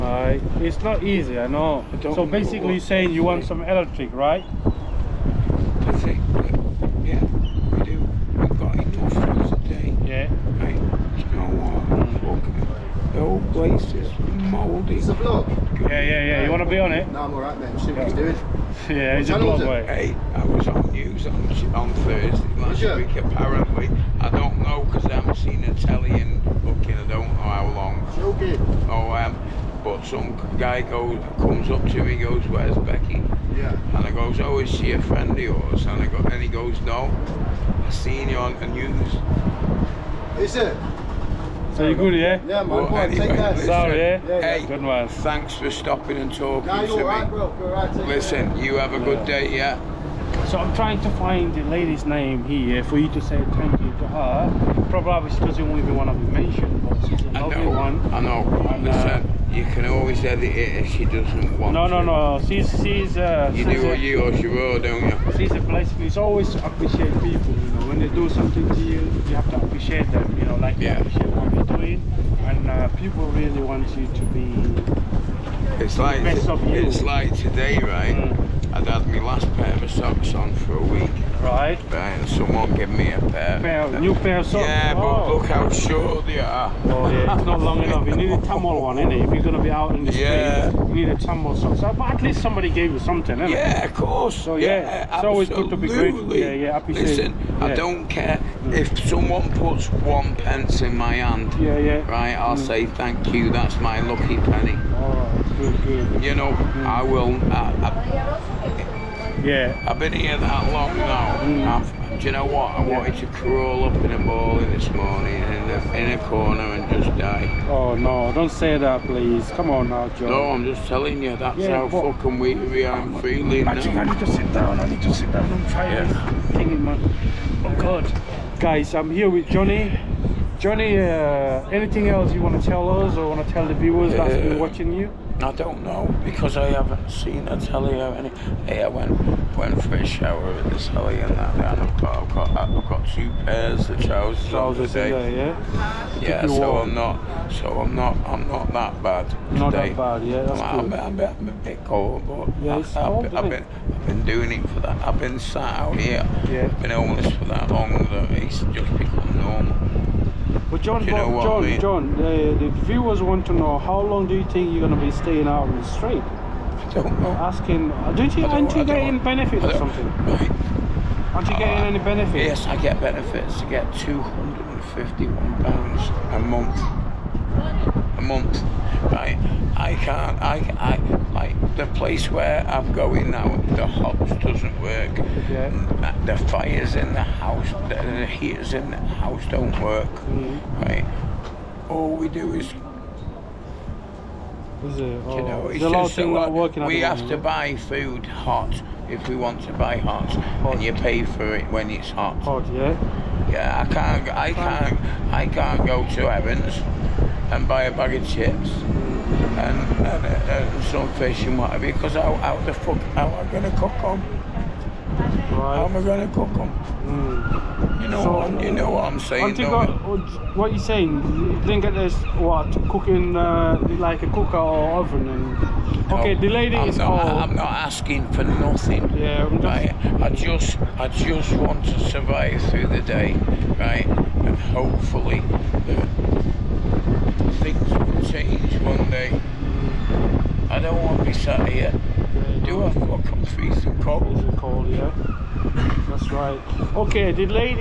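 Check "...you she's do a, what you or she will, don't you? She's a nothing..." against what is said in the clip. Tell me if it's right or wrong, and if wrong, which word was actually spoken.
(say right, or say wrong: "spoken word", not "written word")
wrong: "blessing", not "nothing".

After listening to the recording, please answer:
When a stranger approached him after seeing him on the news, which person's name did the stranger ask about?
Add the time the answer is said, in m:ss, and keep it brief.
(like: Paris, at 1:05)
Becky, at 0:32.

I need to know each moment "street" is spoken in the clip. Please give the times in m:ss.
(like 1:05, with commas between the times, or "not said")
1:30, 2:45.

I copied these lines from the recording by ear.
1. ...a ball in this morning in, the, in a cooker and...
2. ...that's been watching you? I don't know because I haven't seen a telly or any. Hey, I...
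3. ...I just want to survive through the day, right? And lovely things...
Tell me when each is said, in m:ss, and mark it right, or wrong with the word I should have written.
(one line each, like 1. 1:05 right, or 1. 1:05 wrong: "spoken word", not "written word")
1. 1:54 wrong: "corner", not "cooker"
2. 2:14 right
3. 3:50 wrong: "hopefully", not "lovely".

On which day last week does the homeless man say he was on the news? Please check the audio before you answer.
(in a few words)
Thursday.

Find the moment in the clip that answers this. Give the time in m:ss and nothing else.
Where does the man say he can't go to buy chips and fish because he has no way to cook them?
3:26.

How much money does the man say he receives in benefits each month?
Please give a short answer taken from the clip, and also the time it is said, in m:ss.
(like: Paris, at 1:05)
£251, at 2:53.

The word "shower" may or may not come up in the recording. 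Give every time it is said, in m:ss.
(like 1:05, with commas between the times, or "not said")
2:20.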